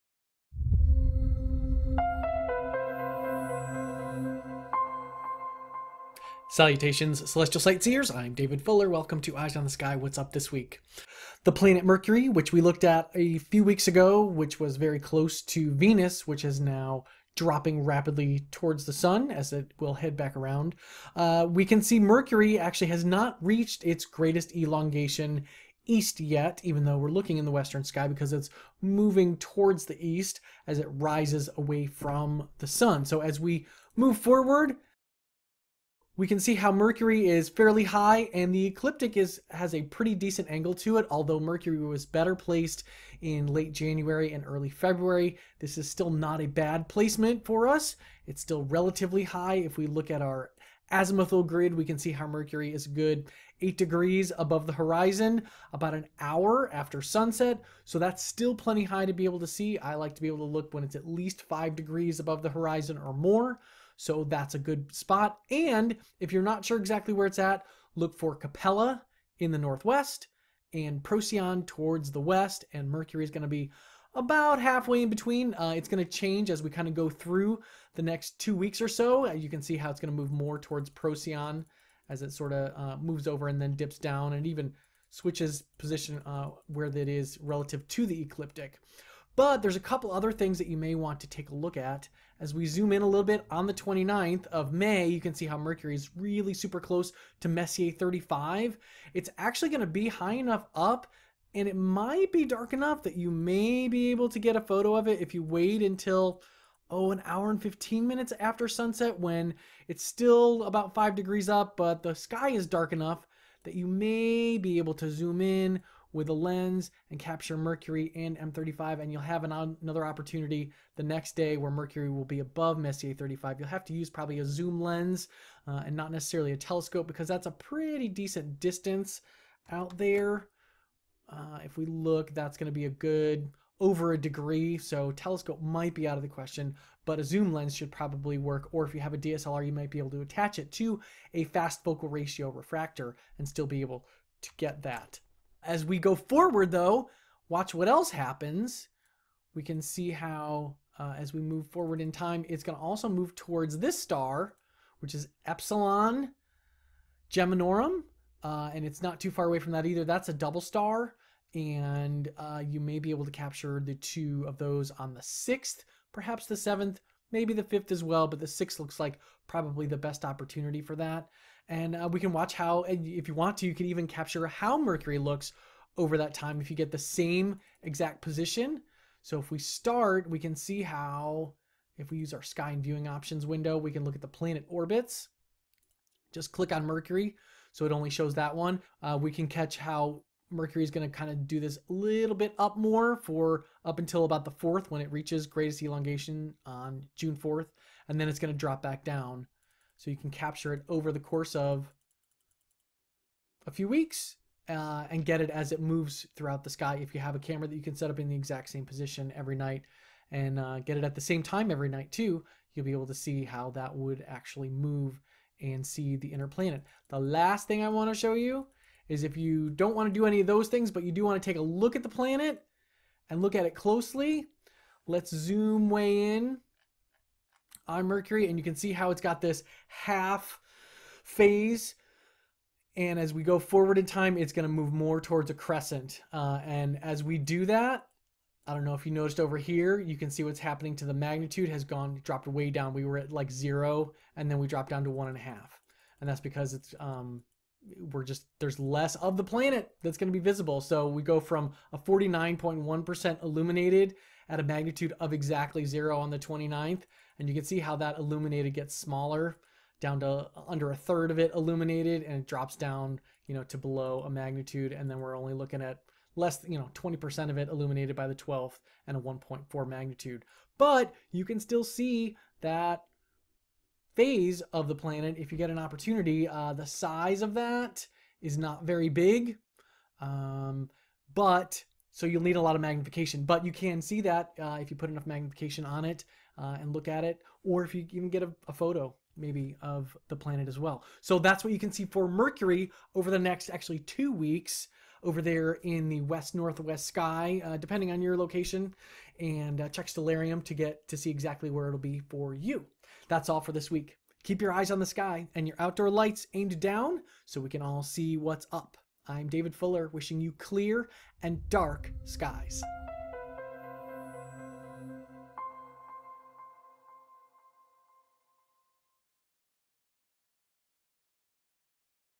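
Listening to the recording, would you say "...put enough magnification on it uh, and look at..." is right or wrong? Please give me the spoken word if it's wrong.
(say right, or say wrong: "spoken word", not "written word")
right.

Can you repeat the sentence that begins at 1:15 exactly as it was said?
Uh, it's going to change as we kind of go through the next two weeks or so.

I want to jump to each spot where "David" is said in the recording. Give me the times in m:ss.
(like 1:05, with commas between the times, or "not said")
0:08, 5:09.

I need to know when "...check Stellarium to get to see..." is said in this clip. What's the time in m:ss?
4:59.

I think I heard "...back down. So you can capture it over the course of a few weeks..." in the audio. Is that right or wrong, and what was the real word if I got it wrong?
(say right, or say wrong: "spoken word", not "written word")
right.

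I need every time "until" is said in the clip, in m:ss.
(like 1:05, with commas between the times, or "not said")
1:45, 3:13.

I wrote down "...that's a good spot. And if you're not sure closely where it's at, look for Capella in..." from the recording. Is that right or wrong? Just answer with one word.
wrong.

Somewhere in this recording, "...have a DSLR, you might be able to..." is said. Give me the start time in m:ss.
2:18.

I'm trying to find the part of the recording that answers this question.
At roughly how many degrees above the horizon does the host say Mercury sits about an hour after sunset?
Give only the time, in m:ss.
0:53.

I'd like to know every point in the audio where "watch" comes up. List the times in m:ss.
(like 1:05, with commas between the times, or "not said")
2:27, 2:52.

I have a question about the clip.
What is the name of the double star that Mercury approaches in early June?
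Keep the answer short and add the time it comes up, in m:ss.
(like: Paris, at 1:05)
Epsilon Geminorum, at 2:35.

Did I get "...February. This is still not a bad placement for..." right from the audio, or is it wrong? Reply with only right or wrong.
right.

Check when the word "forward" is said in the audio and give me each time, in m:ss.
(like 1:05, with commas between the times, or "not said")
0:34, 2:26, 2:31, 3:53.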